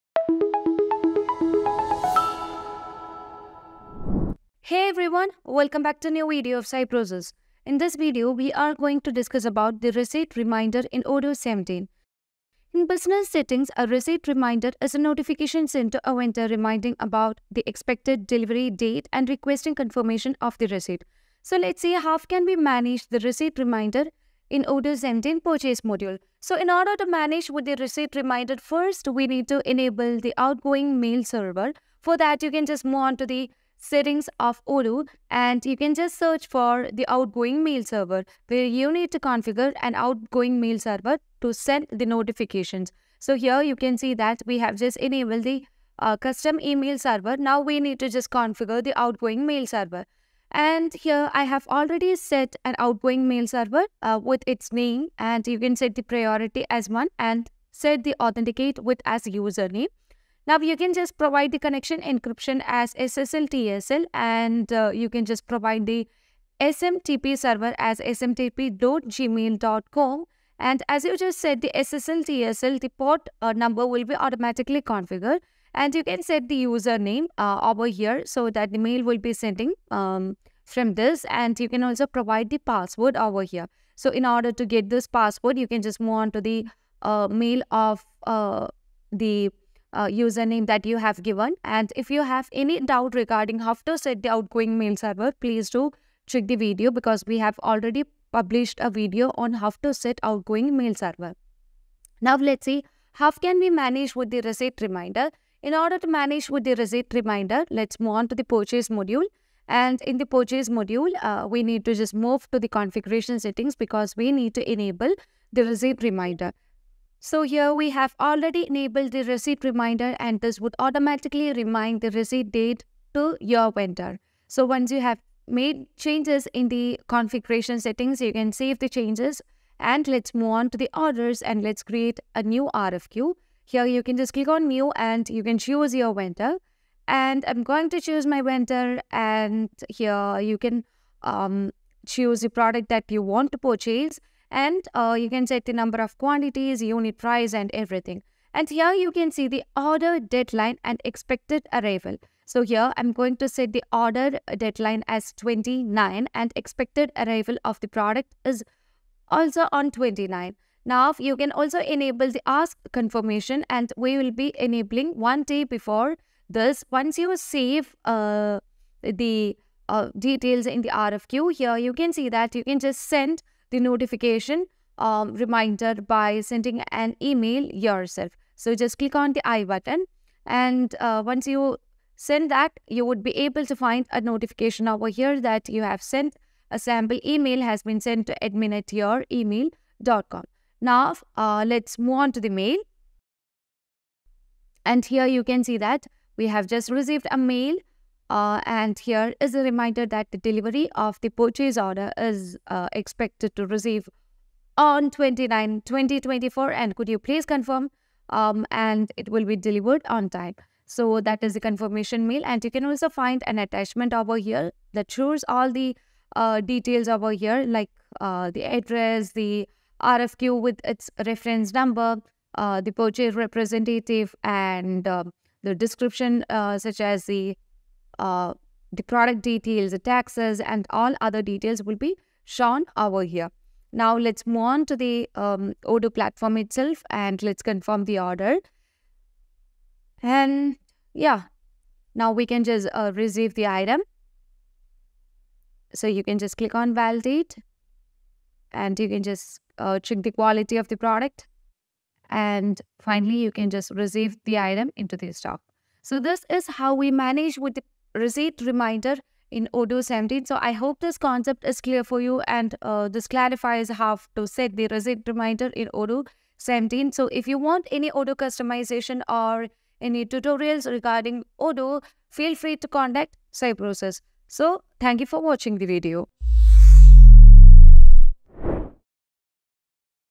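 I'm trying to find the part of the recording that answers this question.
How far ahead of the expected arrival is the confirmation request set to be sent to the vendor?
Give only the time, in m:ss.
2:45.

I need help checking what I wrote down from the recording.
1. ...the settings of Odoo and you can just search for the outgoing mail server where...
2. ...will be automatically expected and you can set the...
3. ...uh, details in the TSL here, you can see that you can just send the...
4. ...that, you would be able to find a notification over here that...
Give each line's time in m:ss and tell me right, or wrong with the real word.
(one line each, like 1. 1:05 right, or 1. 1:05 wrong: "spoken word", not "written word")
1. 0:33 right
2. 1:13 wrong: "configured", not "expected"
3. 2:49 wrong: "RFQ", not "TSL"
4. 3:02 right.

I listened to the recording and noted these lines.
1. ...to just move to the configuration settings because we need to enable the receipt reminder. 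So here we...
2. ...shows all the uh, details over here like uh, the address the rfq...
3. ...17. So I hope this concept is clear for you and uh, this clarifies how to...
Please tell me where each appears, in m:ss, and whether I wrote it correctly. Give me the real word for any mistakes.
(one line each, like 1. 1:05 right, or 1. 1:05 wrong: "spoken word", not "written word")
1. 1:51 right
2. 3:35 right
3. 4:20 right.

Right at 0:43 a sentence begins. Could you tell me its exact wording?
So here you can see that we have just enabled the uh, custom email server.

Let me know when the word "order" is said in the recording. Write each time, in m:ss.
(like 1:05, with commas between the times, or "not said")
0:26, 1:24, 1:45, 2:10, 2:29, 2:33, 3:21, 3:58.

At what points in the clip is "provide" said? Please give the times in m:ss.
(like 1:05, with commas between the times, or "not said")
1:01, 1:05, 1:22.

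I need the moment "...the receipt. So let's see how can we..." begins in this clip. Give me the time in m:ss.
0:20.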